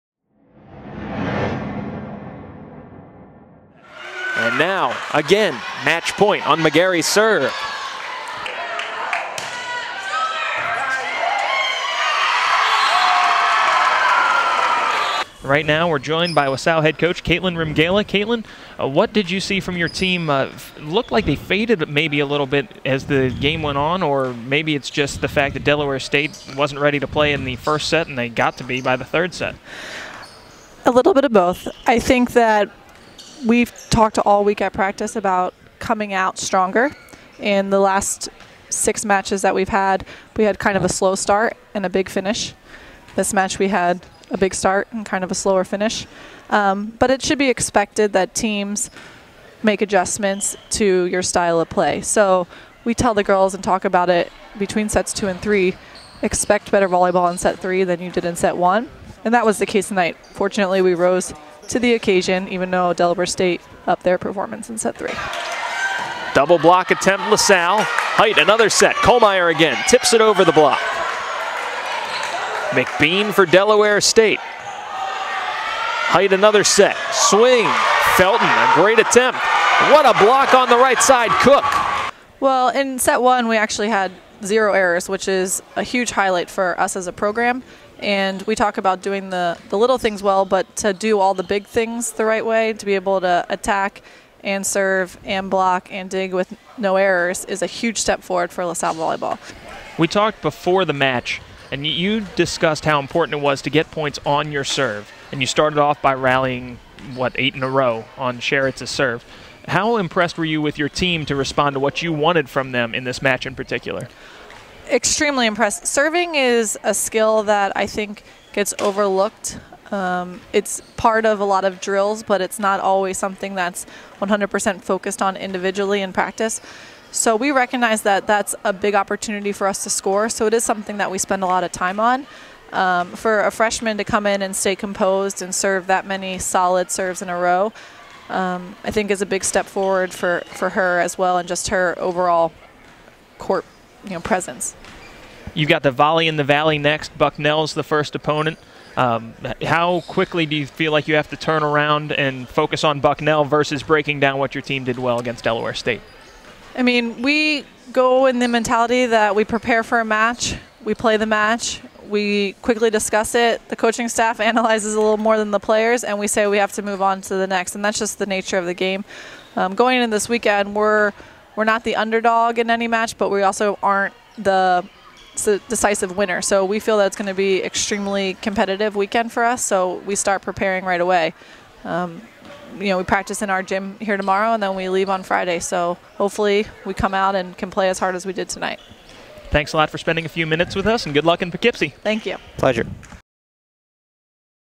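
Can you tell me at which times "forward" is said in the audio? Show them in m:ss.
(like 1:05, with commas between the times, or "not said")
1:38, 2:19.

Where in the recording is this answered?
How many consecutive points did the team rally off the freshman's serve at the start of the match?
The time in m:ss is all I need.
1:47.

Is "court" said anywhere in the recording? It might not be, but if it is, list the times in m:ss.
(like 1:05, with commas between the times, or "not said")
2:23.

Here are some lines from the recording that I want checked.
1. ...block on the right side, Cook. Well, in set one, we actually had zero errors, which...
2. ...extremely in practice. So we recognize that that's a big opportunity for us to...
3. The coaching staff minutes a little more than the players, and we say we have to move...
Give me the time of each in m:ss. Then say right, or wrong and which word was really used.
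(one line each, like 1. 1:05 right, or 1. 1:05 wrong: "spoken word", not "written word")
1. 1:20 right
2. 2:05 wrong: "individually", not "extremely"
3. 2:43 wrong: "analyzes", not "minutes".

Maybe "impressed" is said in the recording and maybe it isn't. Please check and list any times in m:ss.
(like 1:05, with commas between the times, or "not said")
1:49, 1:55.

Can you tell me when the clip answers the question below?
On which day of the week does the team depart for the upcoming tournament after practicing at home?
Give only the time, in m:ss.
3:05.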